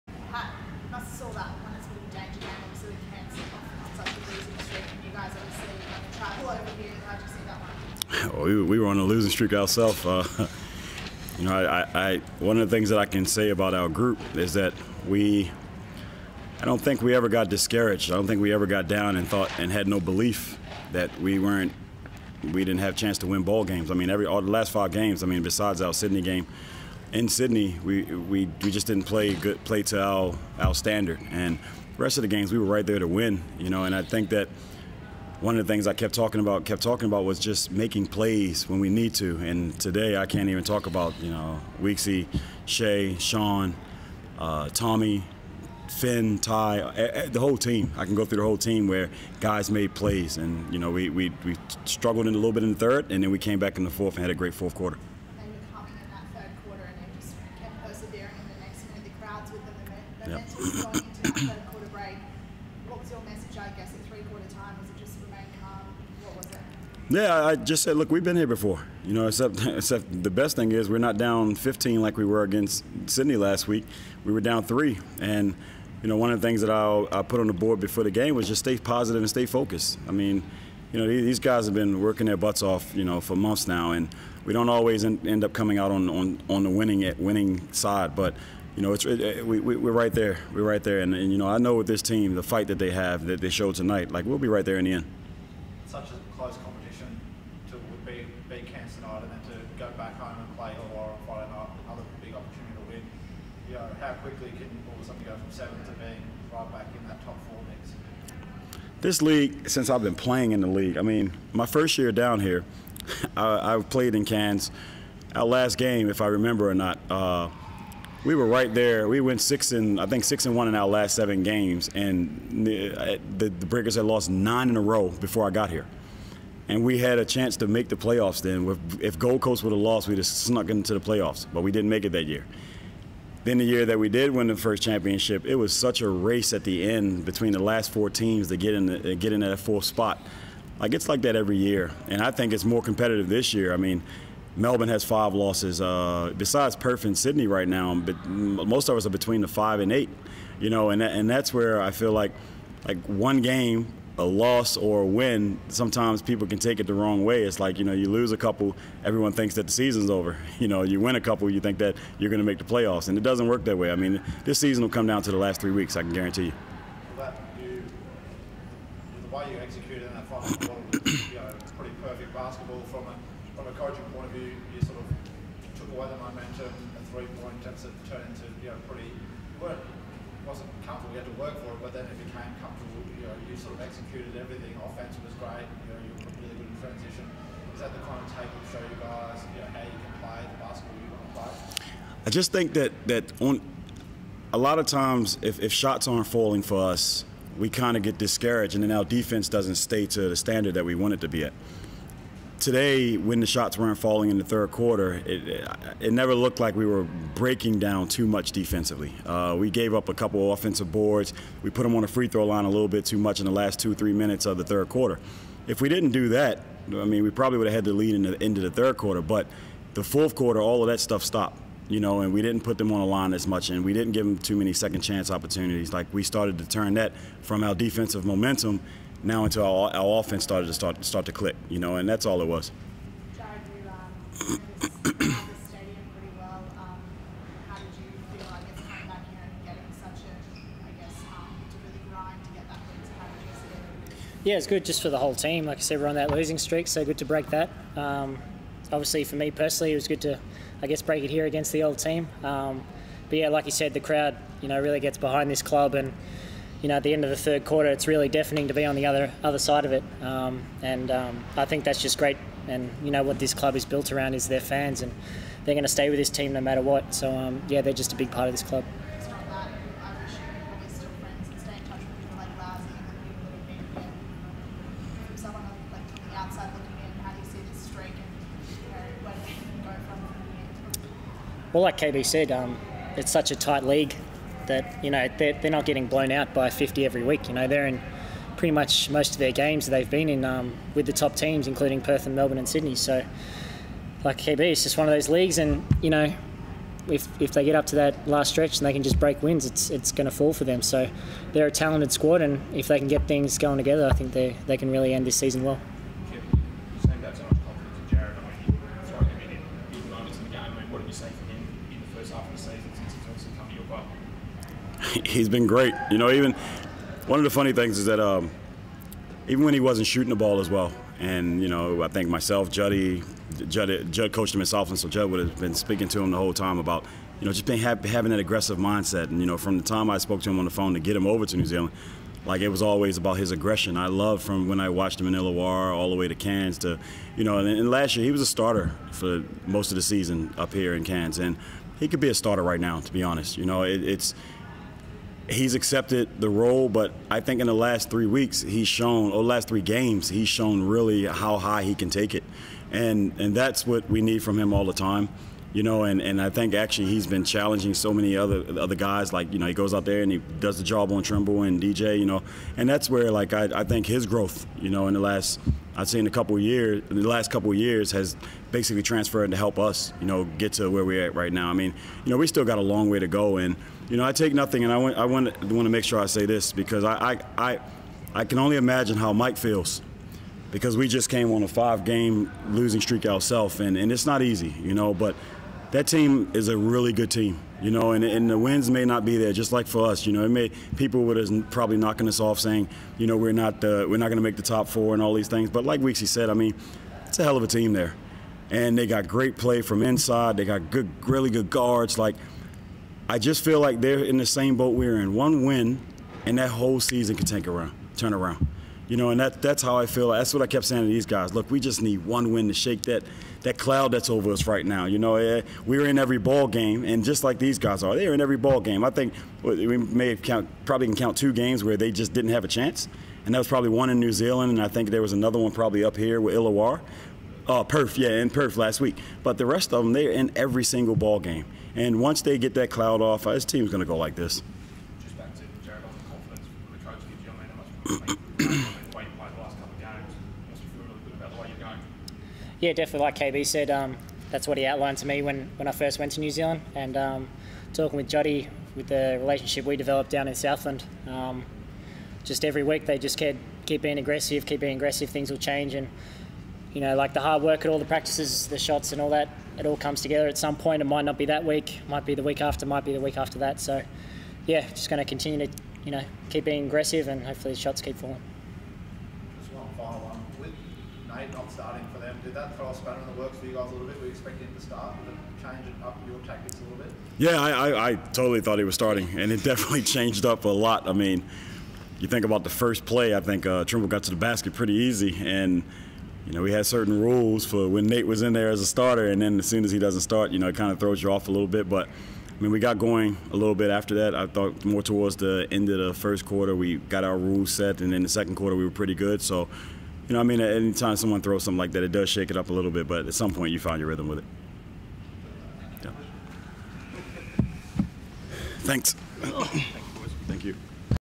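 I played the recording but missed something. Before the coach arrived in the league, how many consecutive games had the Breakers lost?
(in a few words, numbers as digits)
9.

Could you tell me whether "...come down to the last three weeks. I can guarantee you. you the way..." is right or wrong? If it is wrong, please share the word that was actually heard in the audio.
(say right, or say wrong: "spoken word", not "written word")
right.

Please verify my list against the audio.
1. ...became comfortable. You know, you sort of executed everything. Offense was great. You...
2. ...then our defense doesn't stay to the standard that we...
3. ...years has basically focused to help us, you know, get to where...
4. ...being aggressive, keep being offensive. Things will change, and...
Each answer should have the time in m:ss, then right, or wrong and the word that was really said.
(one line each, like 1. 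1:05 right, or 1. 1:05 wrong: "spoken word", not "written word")
1. 3:02 right
2. 3:18 right
3. 6:07 wrong: "transferred", not "focused"
4. 7:34 wrong: "aggressive", not "offensive".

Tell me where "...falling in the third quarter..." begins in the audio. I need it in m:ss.
3:23.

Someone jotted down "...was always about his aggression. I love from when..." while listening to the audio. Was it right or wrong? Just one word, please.
right.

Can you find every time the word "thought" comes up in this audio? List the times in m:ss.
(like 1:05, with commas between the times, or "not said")
0:19, 7:58, 8:14.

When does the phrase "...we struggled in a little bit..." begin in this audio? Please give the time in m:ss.
0:51.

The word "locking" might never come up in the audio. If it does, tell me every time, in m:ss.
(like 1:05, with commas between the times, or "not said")
not said.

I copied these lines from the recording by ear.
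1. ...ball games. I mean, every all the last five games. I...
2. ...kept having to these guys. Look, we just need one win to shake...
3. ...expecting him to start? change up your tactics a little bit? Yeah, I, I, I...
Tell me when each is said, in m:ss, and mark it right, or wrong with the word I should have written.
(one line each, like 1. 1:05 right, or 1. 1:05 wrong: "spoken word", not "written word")
1. 0:23 right
2. 6:50 wrong: "saying", not "having"
3. 7:54 right.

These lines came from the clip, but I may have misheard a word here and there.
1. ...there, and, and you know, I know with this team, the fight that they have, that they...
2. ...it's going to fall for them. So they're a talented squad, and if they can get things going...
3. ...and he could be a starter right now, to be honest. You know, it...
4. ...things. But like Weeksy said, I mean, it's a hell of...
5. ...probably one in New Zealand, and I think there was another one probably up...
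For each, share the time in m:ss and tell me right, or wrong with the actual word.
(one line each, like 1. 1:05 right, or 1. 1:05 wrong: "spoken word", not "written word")
1. 1:30 right
2. 4:59 right
3. 5:41 right
4. 6:35 right
5. 7:03 right.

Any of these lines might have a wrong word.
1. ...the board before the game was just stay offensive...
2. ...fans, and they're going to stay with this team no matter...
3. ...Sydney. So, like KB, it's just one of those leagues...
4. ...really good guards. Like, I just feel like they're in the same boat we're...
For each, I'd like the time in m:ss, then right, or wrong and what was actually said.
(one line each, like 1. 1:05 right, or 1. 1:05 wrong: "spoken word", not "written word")
1. 1:17 wrong: "positive", not "offensive"
2. 4:24 right
3. 4:52 right
4. 6:41 right.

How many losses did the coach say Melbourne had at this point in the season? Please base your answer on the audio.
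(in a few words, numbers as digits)
5.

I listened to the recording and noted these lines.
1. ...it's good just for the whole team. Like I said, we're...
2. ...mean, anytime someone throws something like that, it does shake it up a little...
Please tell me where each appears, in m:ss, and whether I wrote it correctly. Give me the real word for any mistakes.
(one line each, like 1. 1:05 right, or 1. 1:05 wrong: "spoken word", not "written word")
1. 4:04 right
2. 8:20 right.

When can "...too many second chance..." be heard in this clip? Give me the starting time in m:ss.
3:44.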